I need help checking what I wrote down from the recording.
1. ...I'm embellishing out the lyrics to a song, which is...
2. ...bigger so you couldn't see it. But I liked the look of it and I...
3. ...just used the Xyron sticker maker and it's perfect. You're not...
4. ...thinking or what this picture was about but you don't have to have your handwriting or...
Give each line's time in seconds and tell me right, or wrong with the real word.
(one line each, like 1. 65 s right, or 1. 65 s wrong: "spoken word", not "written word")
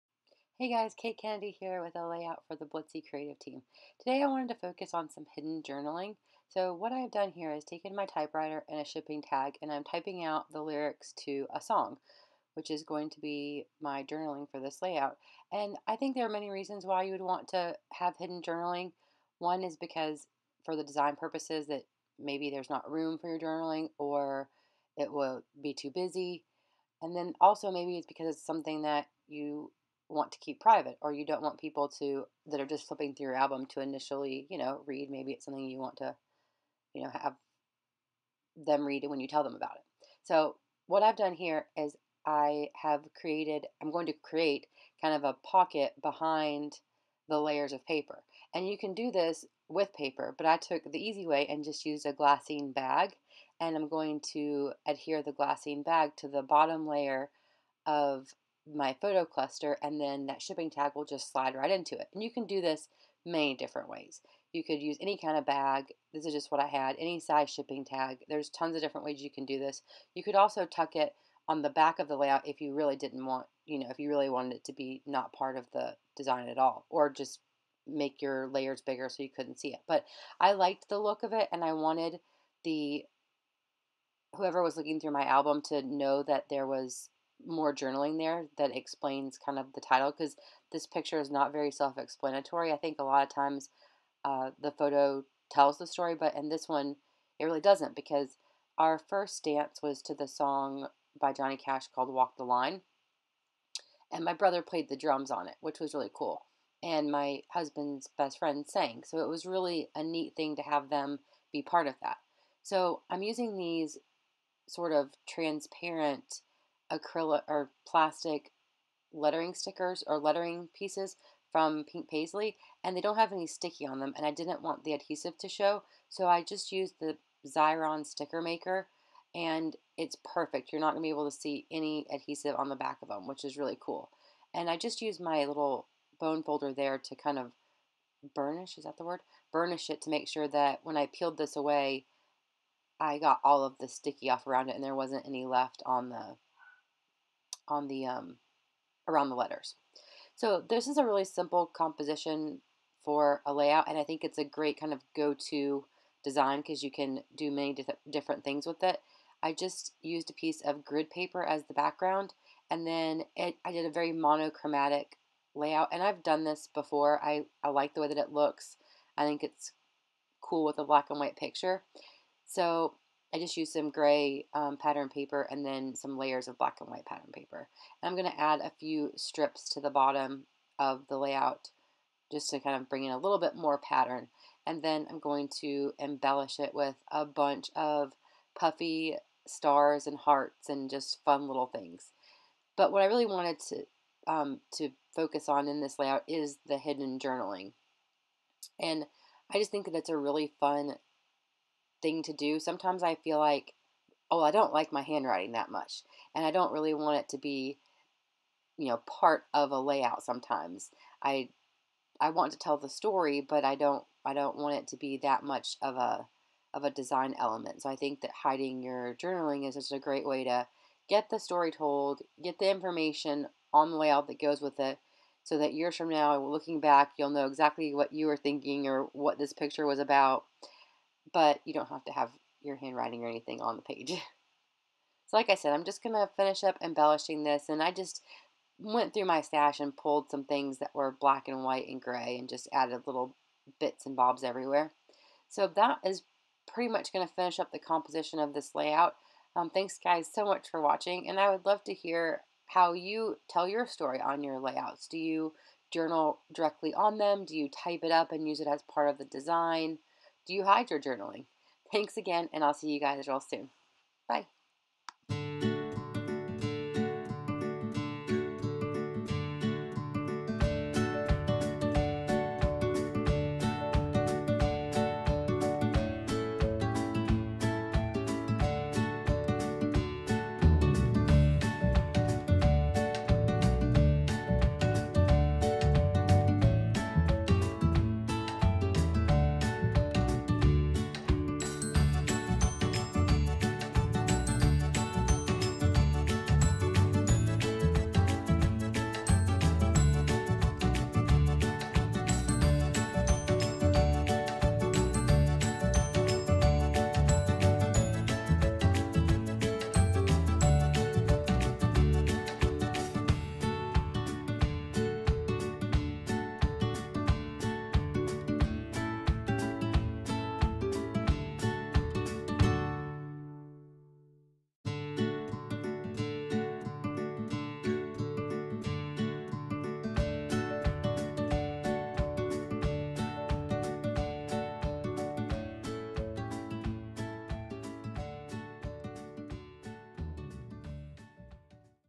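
1. 9 s wrong: "typing", not "embellishing"
2. 78 s right
3. 126 s right
4. 228 s right.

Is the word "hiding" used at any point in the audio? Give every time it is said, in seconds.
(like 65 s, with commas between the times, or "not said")
218 s.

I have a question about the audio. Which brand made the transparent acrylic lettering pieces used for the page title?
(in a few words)
Pink Paisley.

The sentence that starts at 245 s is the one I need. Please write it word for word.
So that is pretty much going to finish up the composition of this layout.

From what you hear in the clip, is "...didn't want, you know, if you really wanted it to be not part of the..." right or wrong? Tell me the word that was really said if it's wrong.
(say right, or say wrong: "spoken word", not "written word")
right.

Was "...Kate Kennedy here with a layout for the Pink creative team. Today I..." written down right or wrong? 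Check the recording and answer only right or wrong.
wrong.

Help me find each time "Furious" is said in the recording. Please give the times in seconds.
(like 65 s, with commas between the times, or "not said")
not said.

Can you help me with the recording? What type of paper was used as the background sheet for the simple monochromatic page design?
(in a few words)
Grid paper.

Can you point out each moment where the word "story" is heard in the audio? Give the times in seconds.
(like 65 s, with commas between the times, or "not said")
95 s, 212 s, 221 s, 253 s.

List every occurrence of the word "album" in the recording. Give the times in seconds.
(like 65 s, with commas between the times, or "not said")
33 s, 85 s.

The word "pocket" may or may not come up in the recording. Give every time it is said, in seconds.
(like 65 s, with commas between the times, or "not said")
45 s.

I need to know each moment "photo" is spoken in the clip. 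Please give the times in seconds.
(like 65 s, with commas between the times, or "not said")
59 s, 94 s.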